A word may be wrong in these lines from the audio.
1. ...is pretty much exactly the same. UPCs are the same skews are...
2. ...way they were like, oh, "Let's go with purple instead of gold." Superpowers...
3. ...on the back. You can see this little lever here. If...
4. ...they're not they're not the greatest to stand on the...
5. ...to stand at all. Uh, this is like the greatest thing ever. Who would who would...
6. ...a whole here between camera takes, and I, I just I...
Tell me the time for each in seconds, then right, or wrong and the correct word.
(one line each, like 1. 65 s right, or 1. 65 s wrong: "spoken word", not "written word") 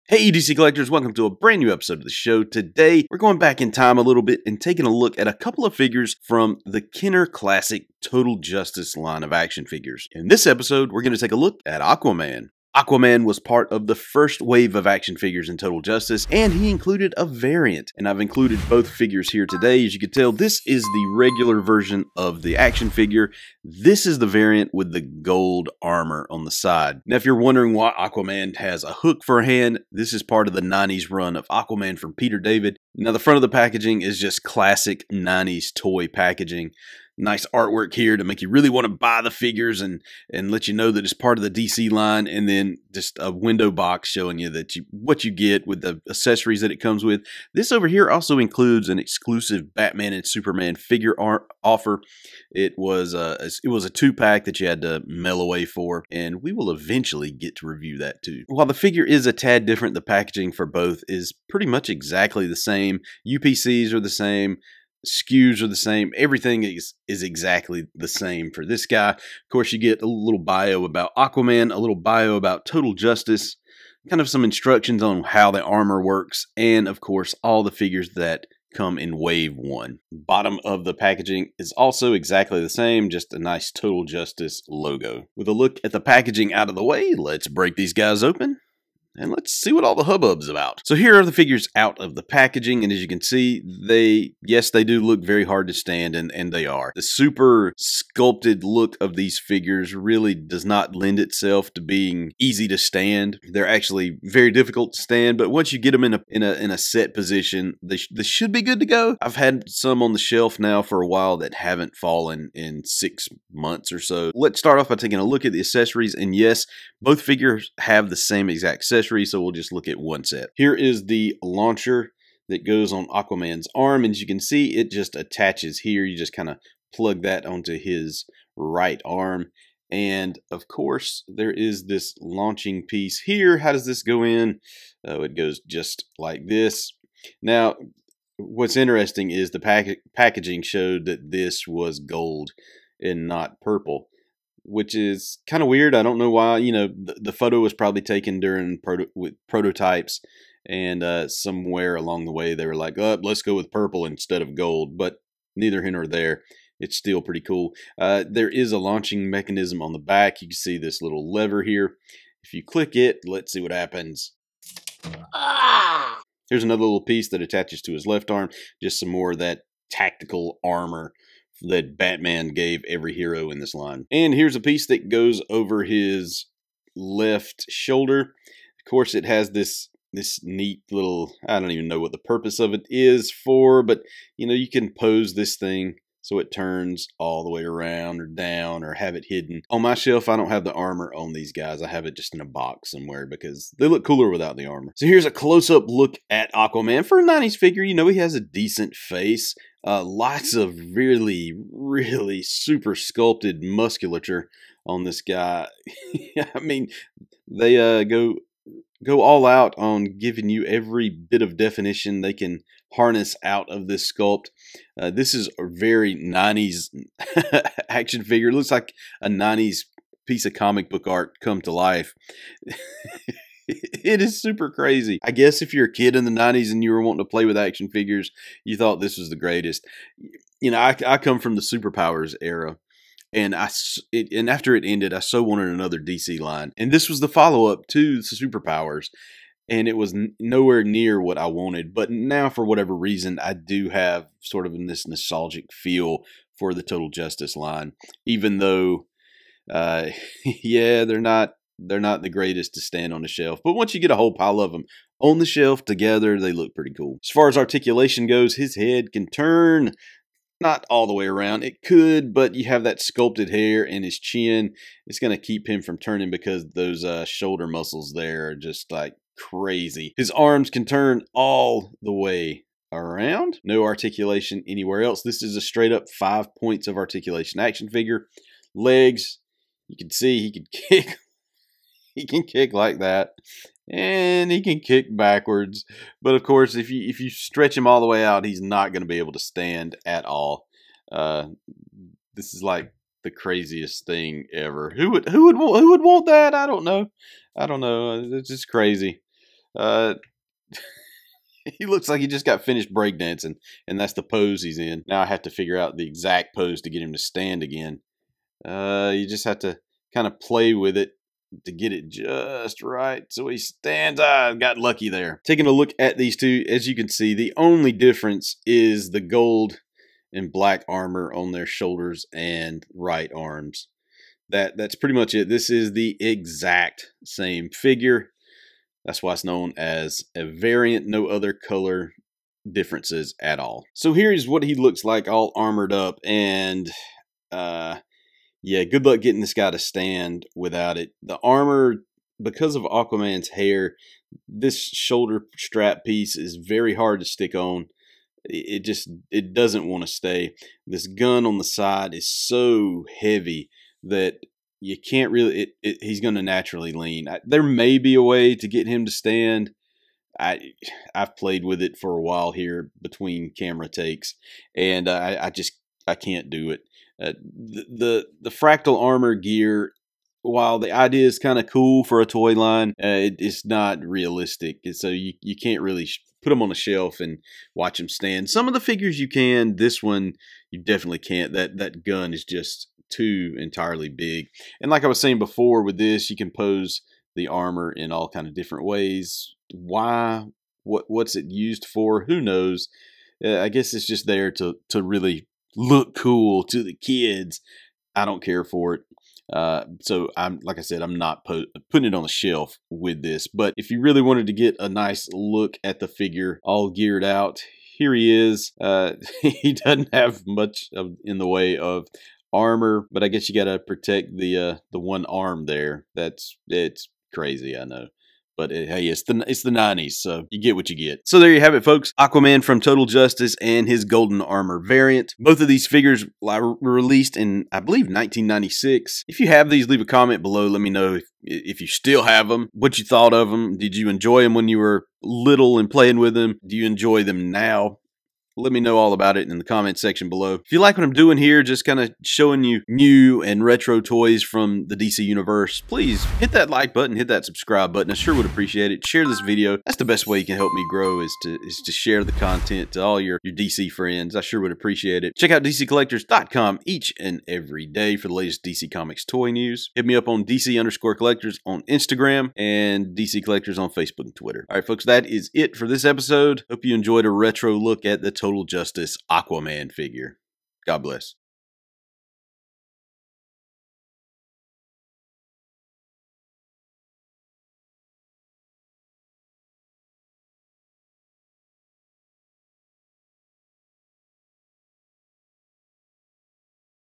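1. 61 s right
2. 152 s wrong: "But", not "Superpowers"
3. 159 s right
4. 251 s right
5. 289 s wrong: "craziest", not "greatest"
6. 362 s wrong: "while", not "whole".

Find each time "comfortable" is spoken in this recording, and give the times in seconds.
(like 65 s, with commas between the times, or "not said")
not said.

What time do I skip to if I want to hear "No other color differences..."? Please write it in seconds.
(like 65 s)
331 s.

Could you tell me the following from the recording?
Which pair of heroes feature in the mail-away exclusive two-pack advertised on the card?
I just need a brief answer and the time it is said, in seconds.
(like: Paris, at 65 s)
Batman and Superman, at 49 s.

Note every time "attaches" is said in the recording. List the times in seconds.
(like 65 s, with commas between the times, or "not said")
125 s, 167 s.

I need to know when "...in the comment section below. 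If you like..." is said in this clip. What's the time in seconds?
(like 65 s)
439 s.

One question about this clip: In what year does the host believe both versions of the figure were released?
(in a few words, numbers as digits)
1996.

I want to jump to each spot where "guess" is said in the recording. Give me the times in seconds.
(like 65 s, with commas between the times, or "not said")
225 s, 393 s, 413 s.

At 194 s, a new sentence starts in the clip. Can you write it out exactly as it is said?
So here's a close-up look at Aquaman.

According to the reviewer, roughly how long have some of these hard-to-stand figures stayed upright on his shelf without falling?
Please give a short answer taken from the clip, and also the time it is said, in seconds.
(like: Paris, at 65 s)
six months, at 112 s.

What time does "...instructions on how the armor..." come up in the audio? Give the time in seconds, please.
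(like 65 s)
74 s.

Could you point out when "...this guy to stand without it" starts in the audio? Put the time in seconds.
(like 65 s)
339 s.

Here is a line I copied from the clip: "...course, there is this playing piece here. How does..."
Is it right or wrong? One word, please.
wrong.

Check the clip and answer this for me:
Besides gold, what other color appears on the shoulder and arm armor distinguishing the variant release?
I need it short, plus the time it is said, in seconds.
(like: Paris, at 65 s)
black, at 320 s.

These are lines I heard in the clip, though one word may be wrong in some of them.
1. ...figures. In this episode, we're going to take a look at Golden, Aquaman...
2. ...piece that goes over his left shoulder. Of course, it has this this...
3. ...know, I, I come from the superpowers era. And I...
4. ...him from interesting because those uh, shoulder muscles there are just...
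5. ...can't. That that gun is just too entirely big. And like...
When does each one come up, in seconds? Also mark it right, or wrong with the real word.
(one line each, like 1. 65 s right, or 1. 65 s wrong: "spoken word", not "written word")
1. 9 s wrong: "Aquaman", not "Golden"
2. 174 s right
3. 230 s right
4. 265 s wrong: "turning", not "interesting"
5. 381 s right.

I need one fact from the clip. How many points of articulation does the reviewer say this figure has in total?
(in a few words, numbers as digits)
5.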